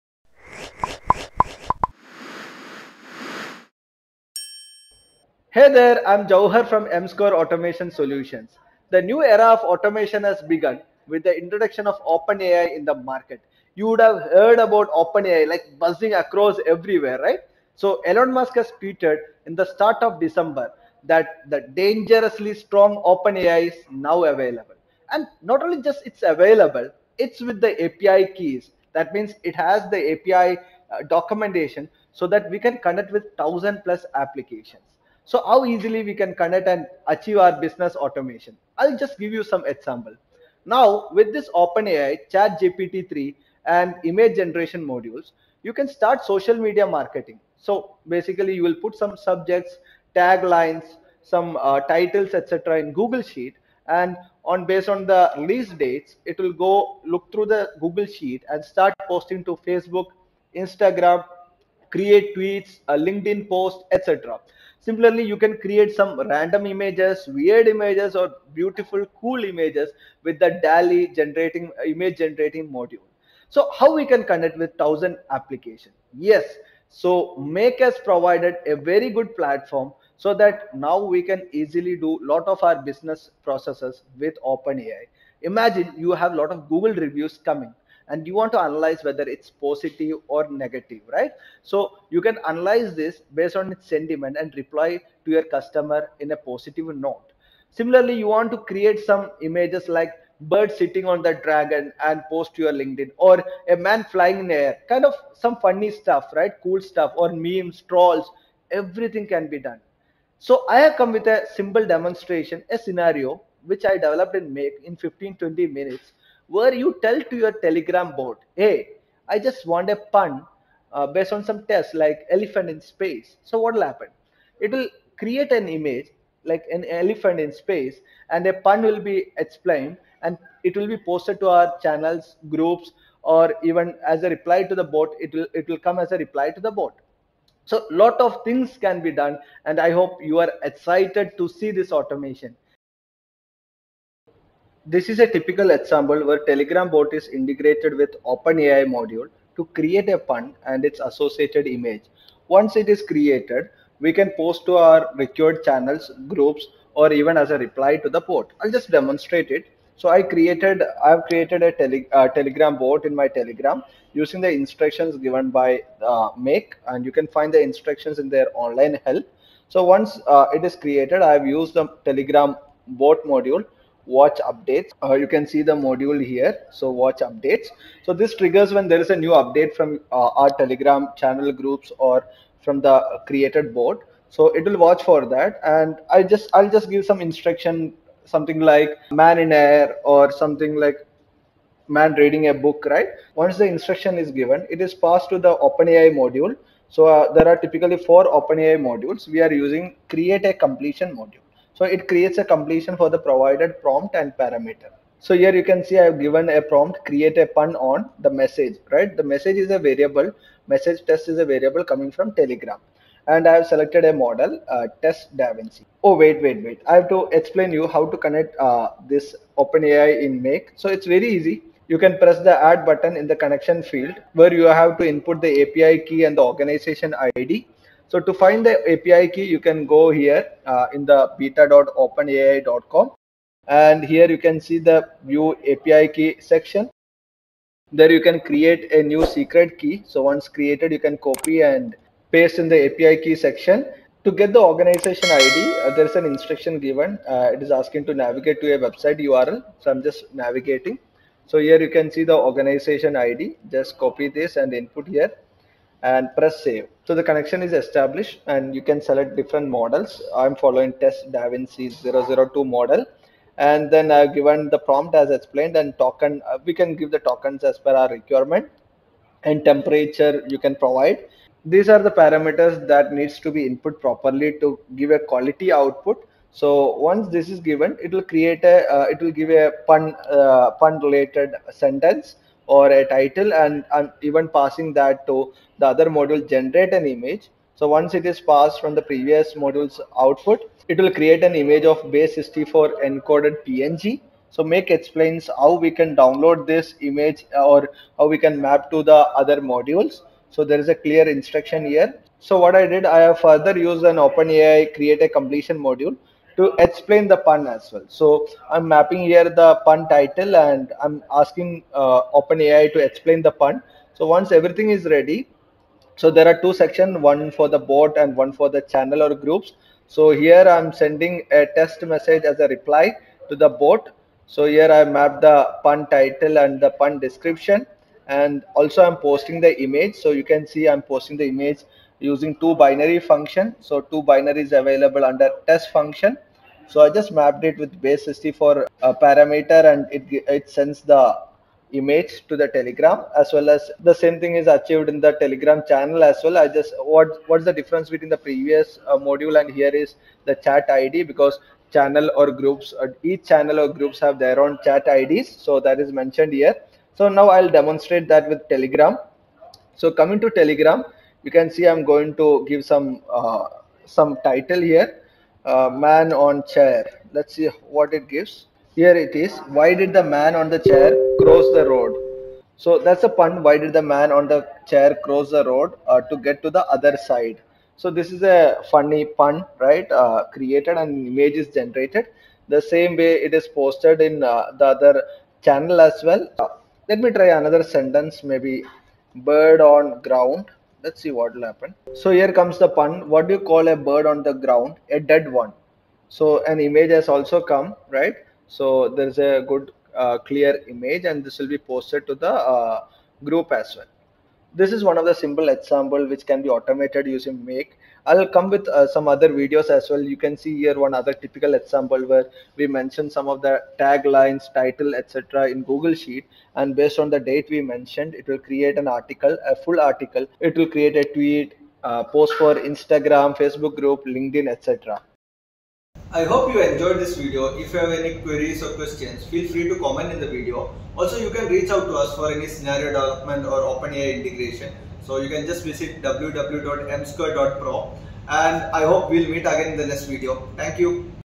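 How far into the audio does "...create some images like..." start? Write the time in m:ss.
1:38.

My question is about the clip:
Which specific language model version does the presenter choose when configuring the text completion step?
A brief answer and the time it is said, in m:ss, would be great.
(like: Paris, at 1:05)
text-davinci 002, at 4:20.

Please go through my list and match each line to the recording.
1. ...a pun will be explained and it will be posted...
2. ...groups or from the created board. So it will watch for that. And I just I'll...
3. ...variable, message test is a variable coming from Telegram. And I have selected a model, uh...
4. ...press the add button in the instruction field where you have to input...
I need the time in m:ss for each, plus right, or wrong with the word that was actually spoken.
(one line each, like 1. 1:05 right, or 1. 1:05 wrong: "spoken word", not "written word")
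1. 2:08 right
2. 3:01 right
3. 3:29 right
4. 3:42 wrong: "connection", not "instruction".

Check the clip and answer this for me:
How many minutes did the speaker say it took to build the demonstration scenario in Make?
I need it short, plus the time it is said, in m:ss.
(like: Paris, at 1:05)
15-20 minutes, at 1:54.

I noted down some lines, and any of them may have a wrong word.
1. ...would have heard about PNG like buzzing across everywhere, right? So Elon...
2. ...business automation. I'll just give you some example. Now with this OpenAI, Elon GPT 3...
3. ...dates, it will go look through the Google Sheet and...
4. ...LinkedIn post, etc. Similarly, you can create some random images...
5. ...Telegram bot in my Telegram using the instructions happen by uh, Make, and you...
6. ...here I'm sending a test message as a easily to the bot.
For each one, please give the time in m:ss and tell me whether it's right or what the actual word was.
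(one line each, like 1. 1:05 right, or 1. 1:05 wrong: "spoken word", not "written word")
1. 0:13 wrong: "OpenAI", not "PNG"
2. 0:37 wrong: "Chat", not "Elon"
3. 0:55 right
4. 1:02 right
5. 2:42 wrong: "given", not "happen"
6. 5:20 wrong: "reply", not "easily".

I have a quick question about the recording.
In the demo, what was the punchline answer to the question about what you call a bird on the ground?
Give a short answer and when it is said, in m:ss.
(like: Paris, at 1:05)
a dead one, at 6:35.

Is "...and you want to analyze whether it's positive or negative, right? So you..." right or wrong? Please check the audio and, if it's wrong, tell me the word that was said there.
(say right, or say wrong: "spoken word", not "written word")
right.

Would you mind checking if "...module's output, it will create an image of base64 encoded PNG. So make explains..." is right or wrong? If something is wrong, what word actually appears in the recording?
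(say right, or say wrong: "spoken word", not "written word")
right.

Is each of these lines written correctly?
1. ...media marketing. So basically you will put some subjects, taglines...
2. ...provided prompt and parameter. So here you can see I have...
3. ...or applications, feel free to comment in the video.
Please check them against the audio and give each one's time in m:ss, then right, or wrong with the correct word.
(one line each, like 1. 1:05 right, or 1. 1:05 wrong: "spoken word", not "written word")
1. 0:46 right
2. 3:23 right
3. 7:08 wrong: "questions", not "applications".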